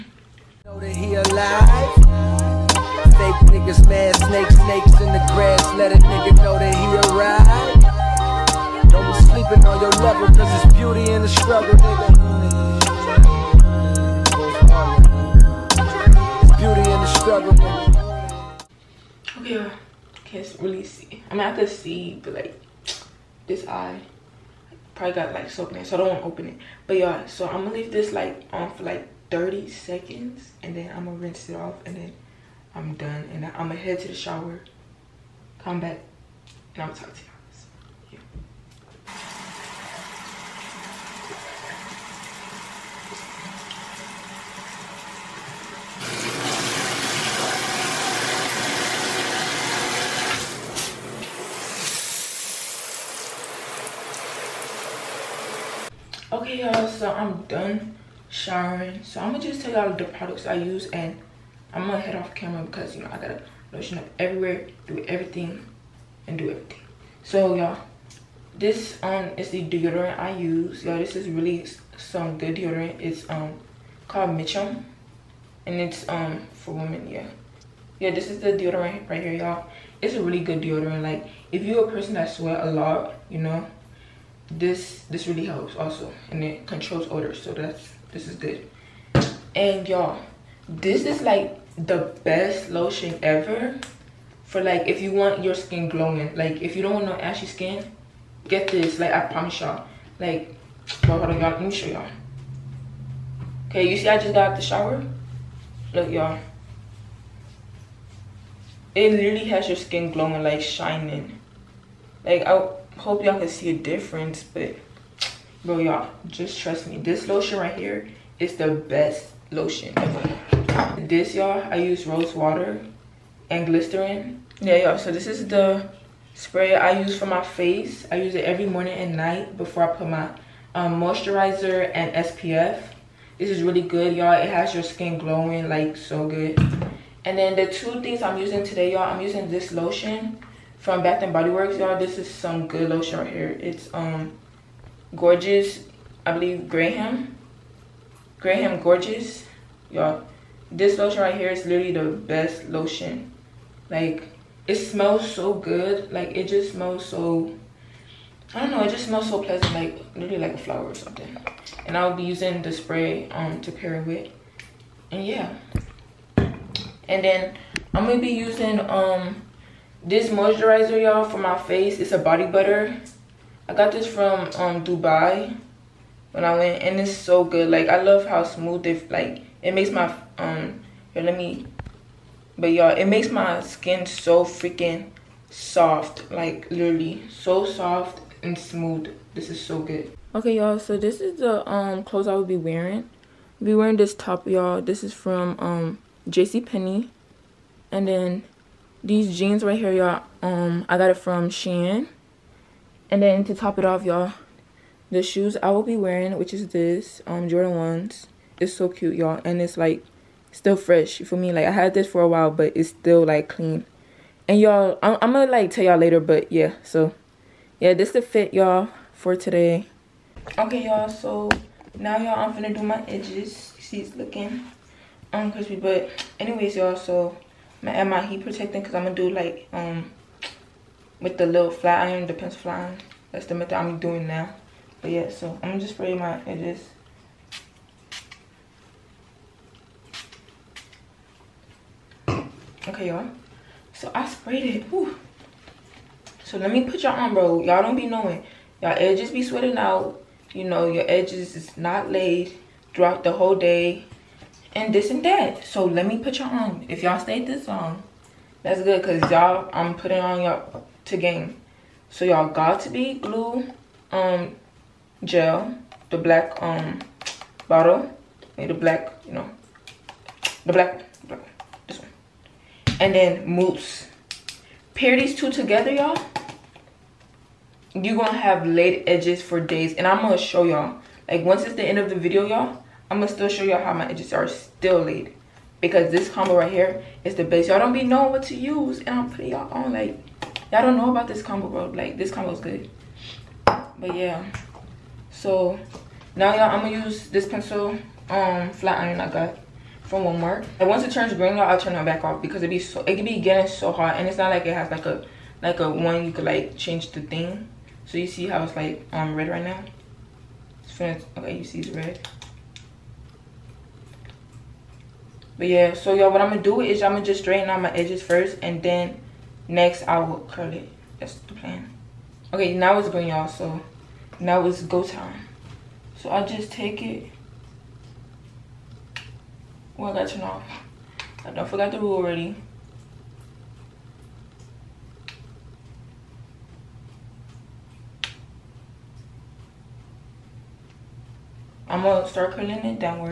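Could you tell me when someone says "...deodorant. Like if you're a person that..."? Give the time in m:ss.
1:20.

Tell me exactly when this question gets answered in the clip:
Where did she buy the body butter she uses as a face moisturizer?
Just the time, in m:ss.
2:54.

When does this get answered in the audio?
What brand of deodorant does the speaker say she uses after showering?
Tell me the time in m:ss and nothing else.
1:14.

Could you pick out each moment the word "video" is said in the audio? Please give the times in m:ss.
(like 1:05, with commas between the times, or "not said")
4:42.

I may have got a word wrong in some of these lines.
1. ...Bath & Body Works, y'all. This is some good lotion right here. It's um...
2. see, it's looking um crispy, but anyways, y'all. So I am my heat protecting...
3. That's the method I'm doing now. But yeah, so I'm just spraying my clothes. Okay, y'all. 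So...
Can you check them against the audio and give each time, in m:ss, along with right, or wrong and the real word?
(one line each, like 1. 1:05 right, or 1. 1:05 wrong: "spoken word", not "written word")
1. 2:21 right
2. 3:43 right
3. 3:53 wrong: "edges", not "clothes".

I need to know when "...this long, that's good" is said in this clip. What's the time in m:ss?
4:17.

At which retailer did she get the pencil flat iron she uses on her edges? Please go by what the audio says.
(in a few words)
Walmart.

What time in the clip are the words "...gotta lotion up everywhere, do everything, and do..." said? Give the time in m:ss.
1:03.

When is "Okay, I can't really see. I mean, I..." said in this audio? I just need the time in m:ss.
0:19.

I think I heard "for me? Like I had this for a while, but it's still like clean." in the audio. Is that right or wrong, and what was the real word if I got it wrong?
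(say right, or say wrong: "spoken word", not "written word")
right.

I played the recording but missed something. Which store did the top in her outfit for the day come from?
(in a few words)
JC Penney.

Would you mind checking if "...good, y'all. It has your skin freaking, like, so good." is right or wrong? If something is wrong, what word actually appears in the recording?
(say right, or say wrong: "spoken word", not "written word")
wrong: "glowing", not "freaking".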